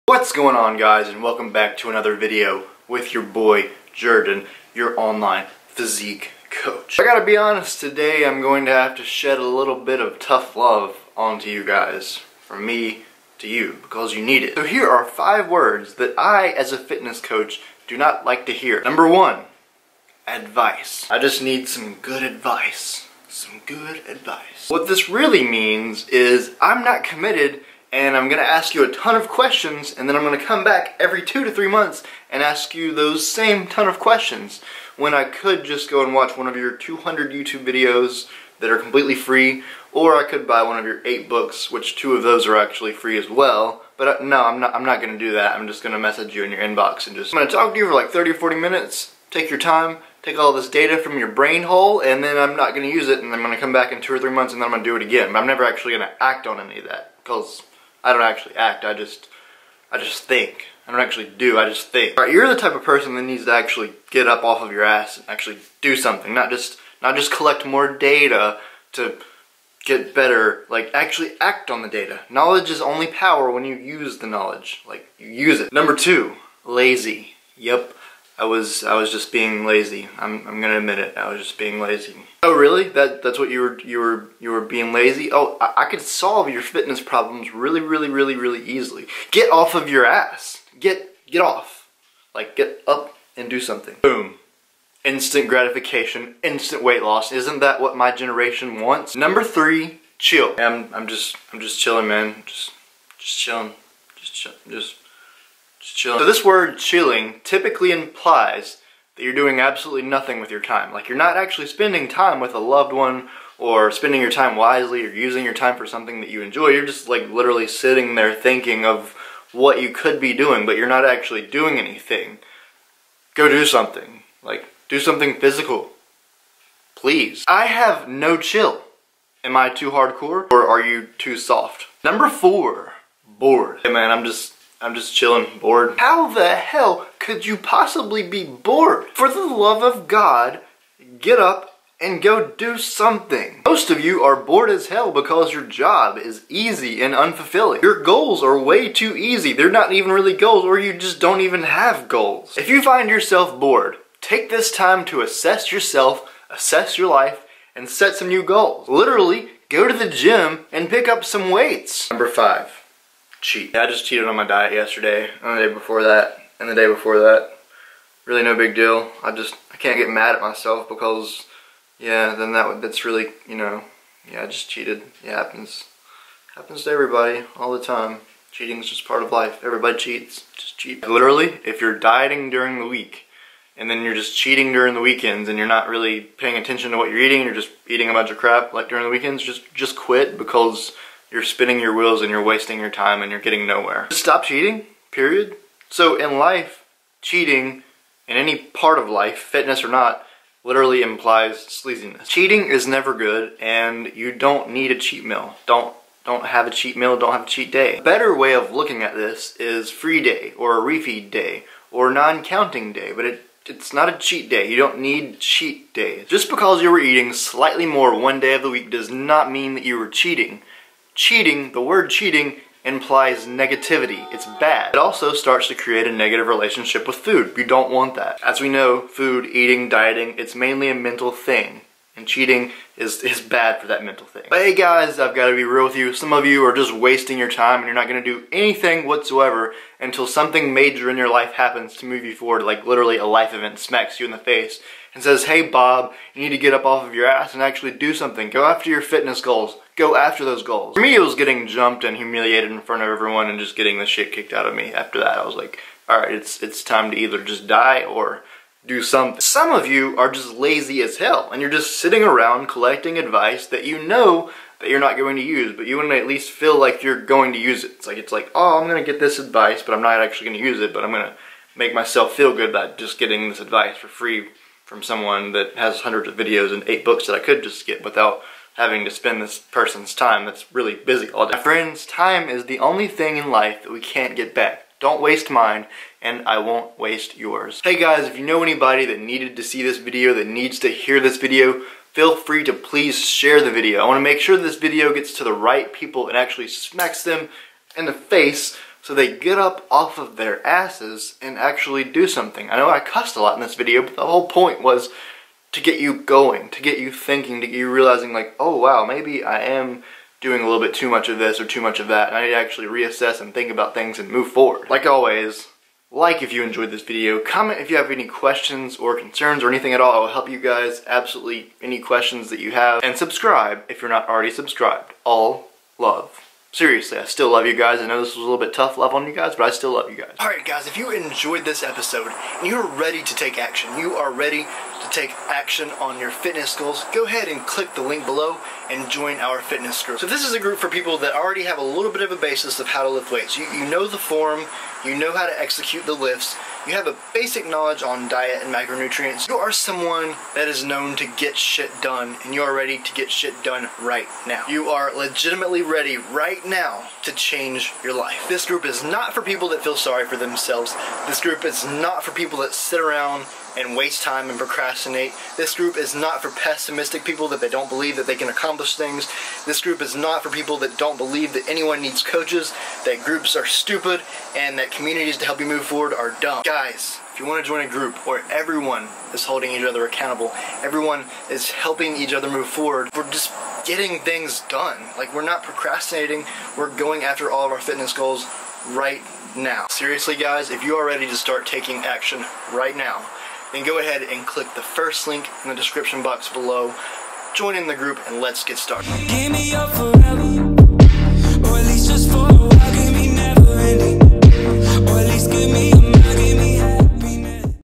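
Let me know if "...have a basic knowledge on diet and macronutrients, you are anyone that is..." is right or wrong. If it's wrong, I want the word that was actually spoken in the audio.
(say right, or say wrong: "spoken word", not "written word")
wrong: "someone", not "anyone".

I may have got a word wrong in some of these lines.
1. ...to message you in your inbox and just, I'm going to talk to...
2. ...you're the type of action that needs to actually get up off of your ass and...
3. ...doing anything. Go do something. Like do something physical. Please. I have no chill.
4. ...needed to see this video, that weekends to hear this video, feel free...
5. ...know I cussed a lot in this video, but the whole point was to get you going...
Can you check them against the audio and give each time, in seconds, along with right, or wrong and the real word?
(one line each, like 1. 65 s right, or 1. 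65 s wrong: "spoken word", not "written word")
1. 45 s right
2. 62 s wrong: "person", not "action"
3. 121 s right
4. 289 s wrong: "needs", not "weekends"
5. 302 s right.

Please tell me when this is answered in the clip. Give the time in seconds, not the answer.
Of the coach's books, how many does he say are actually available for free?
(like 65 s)
41 s.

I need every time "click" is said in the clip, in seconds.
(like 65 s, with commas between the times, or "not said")
337 s, 394 s.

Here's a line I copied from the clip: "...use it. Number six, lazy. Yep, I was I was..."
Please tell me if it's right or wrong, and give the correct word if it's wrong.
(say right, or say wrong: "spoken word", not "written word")
wrong: "two", not "six".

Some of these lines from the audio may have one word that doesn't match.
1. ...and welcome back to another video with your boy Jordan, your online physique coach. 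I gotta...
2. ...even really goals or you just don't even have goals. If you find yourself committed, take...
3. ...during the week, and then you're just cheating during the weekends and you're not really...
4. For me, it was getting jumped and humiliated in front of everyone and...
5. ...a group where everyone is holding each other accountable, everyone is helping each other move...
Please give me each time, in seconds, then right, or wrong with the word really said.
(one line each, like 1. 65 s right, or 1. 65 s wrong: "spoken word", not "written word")
1. 1 s right
2. 149 s wrong: "bored", not "committed"
3. 182 s right
4. 250 s right
5. 377 s right.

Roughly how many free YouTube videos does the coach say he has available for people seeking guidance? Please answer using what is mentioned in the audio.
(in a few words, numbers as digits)
200.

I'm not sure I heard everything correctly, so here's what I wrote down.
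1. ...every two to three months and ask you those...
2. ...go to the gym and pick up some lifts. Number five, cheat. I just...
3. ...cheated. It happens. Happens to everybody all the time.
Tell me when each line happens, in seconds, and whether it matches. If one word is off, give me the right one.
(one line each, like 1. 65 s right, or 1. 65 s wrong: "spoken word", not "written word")
1. 30 s right
2. 159 s wrong: "weights", not "lifts"
3. 174 s right.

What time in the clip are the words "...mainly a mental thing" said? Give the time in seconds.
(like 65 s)
230 s.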